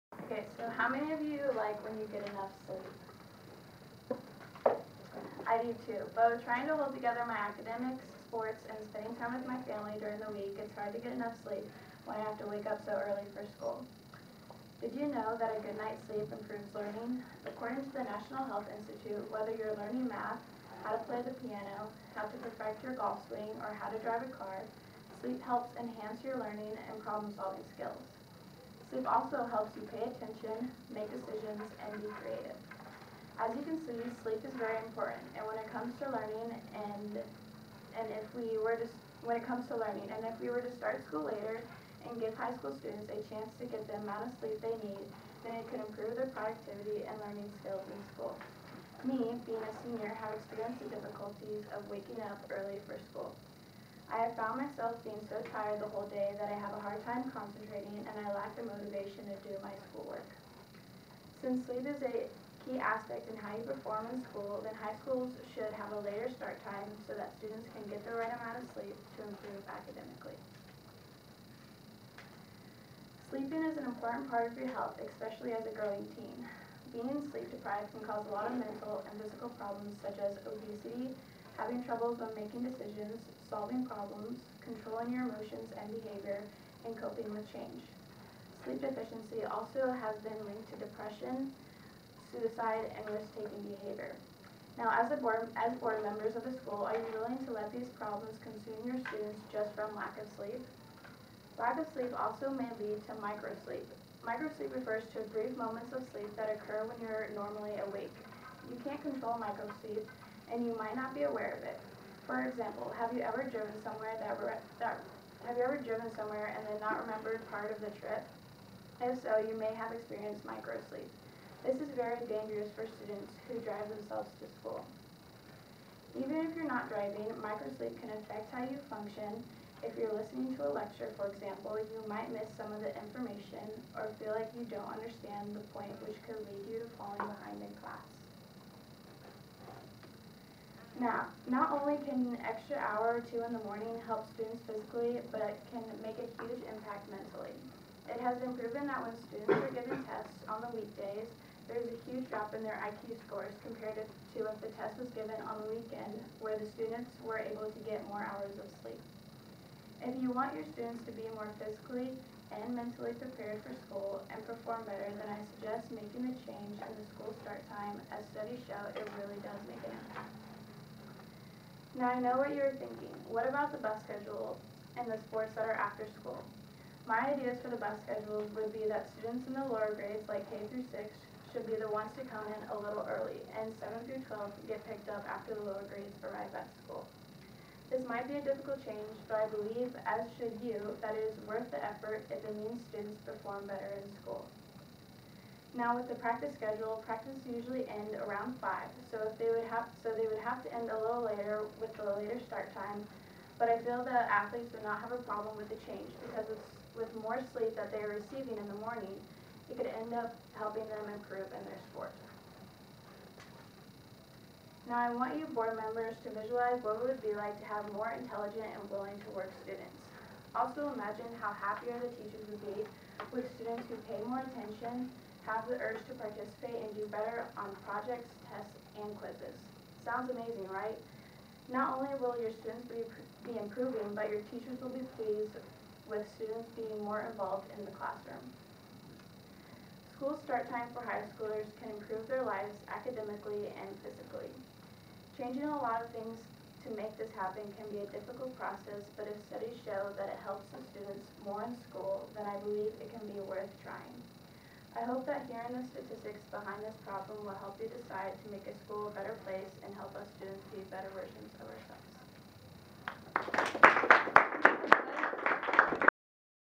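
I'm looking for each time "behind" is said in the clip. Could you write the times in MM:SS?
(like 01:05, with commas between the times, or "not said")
02:17, 04:16.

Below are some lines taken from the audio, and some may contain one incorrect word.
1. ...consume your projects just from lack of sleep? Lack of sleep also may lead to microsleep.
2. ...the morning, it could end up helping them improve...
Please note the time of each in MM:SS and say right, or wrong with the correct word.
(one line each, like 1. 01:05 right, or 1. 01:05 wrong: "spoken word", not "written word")
1. 01:38 wrong: "students", not "projects"
2. 03:28 right.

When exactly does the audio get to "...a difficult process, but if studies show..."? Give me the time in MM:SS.
04:08.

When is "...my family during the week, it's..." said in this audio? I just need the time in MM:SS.
00:09.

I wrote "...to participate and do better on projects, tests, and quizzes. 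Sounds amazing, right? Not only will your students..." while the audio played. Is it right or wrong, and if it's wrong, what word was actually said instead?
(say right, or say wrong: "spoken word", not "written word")
right.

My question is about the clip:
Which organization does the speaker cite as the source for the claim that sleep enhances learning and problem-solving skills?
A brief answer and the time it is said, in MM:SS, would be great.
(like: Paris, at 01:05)
National Health Institute, at 00:18.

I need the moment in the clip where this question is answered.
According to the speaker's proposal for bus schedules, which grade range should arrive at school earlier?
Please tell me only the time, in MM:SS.
03:00.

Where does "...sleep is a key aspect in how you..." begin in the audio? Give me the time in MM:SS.
01:01.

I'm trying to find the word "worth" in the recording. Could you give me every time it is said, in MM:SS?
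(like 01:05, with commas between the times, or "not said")
03:11, 04:13.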